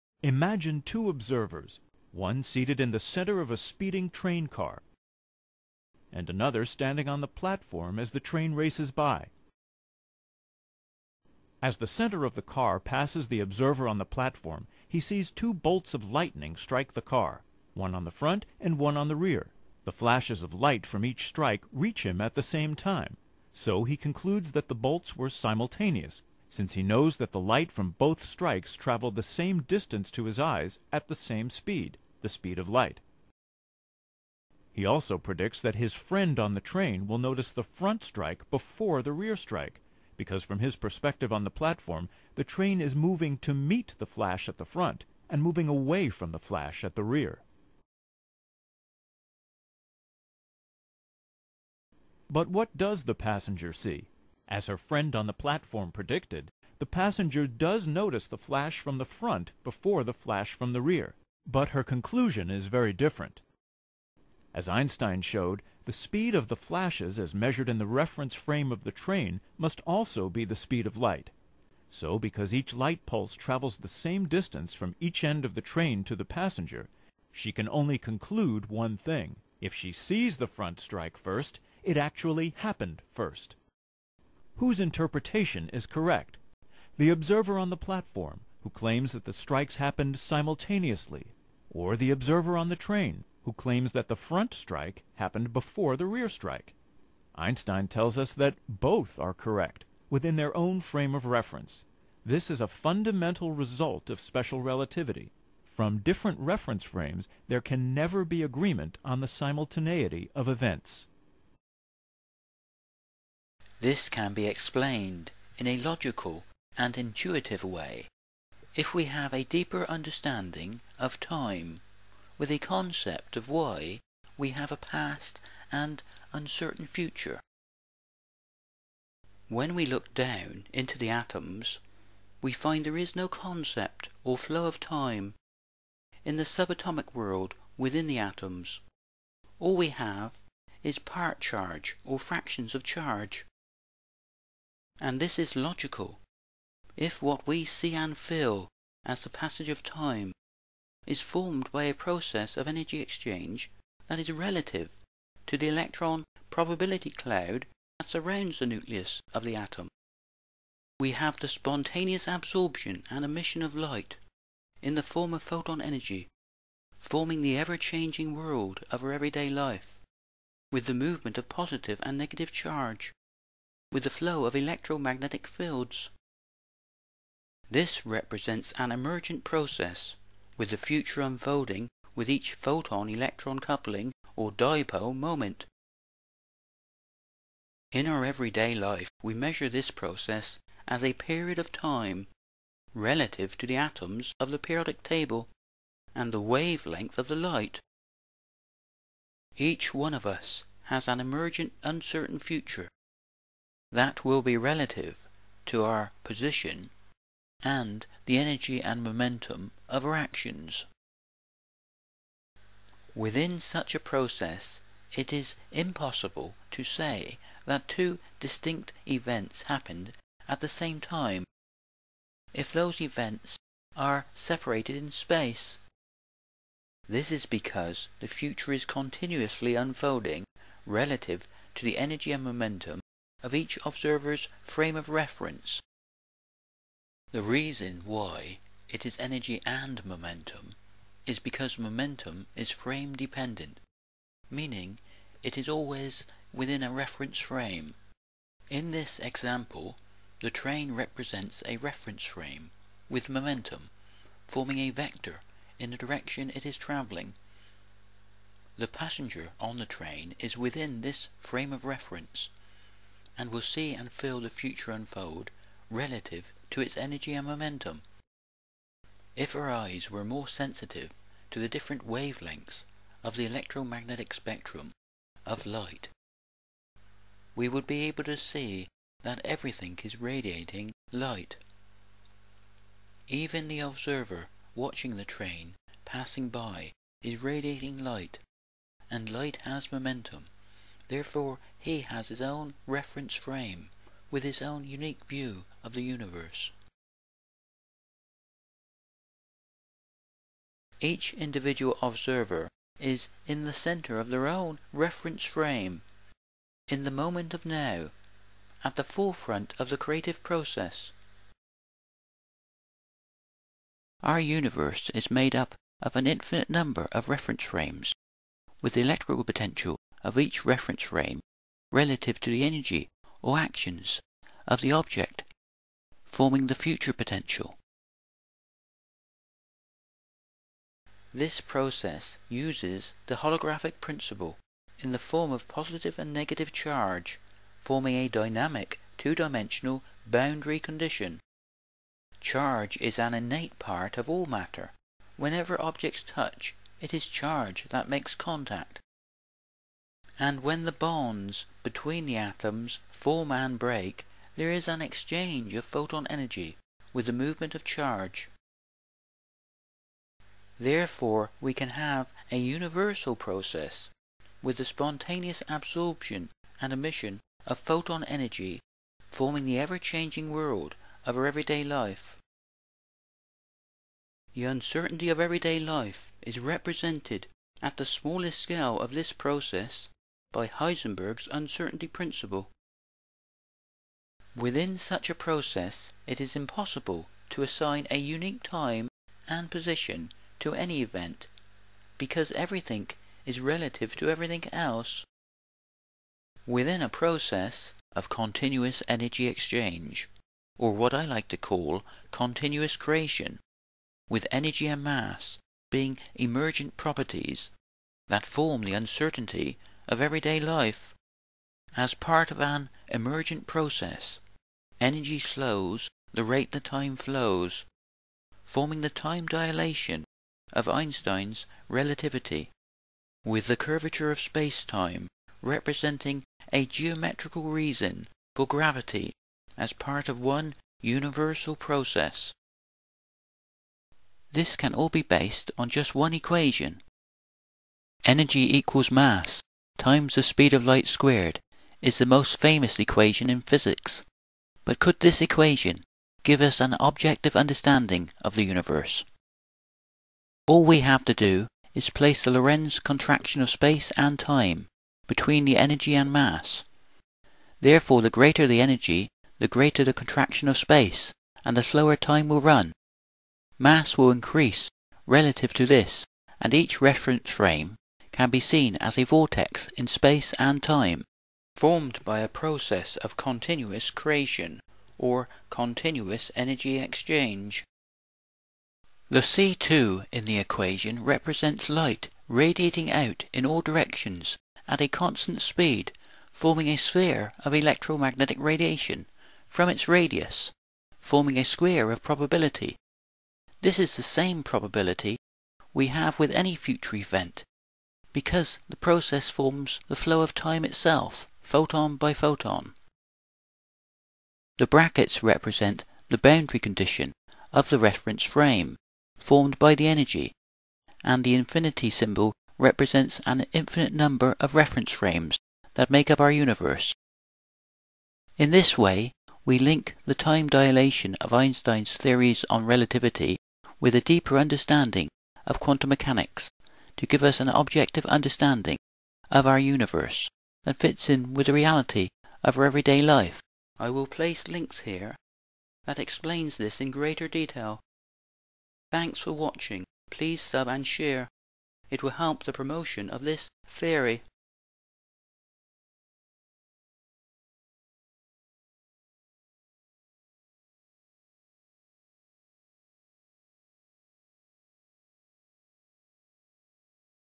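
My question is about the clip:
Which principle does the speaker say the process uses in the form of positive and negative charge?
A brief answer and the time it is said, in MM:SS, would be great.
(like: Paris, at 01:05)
Holographic principle, at 05:33.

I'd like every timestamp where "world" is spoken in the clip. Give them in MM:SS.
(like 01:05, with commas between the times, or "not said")
02:17, 02:48, 06:10.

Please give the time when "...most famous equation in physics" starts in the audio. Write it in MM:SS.
07:22.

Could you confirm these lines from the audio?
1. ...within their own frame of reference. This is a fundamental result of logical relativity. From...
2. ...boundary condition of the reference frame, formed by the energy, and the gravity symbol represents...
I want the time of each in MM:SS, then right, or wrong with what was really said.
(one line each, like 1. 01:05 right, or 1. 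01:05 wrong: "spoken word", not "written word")
1. 01:40 wrong: "special", not "logical"
2. 08:26 wrong: "infinity", not "gravity".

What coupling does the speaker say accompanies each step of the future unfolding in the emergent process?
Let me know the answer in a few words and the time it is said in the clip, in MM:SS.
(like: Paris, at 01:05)
Photon-electron coupling, at 03:02.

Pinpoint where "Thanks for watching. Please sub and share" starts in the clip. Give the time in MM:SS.
08:59.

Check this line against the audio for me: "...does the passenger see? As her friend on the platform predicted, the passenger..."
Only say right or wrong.
right.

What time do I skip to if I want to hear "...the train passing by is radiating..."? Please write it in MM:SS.
04:45.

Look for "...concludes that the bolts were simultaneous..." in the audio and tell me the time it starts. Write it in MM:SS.
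00:23.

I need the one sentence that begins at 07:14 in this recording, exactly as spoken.
This can all be based on just one equation.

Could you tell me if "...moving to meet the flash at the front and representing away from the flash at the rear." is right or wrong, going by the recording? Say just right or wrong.
wrong.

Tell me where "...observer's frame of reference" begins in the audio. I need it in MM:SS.
03:53.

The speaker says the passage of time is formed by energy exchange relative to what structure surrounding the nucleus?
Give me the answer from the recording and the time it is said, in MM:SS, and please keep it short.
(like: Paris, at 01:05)
Electron probability cloud, at 02:35.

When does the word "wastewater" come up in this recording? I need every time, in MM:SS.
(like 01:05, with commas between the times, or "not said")
not said.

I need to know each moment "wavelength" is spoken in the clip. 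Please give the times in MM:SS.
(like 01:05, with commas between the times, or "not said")
03:16, 04:32.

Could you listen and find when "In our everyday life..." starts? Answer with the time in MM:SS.
03:07.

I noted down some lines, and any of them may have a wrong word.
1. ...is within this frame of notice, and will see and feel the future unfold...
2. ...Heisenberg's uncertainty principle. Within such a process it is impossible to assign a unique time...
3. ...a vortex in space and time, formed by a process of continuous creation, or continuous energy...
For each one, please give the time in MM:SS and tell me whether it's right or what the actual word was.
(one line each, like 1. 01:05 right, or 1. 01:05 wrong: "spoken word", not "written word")
1. 04:20 wrong: "reference", not "notice"
2. 06:20 right
3. 07:49 right.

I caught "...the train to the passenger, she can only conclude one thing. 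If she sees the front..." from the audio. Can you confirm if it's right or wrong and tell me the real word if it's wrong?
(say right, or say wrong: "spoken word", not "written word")
right.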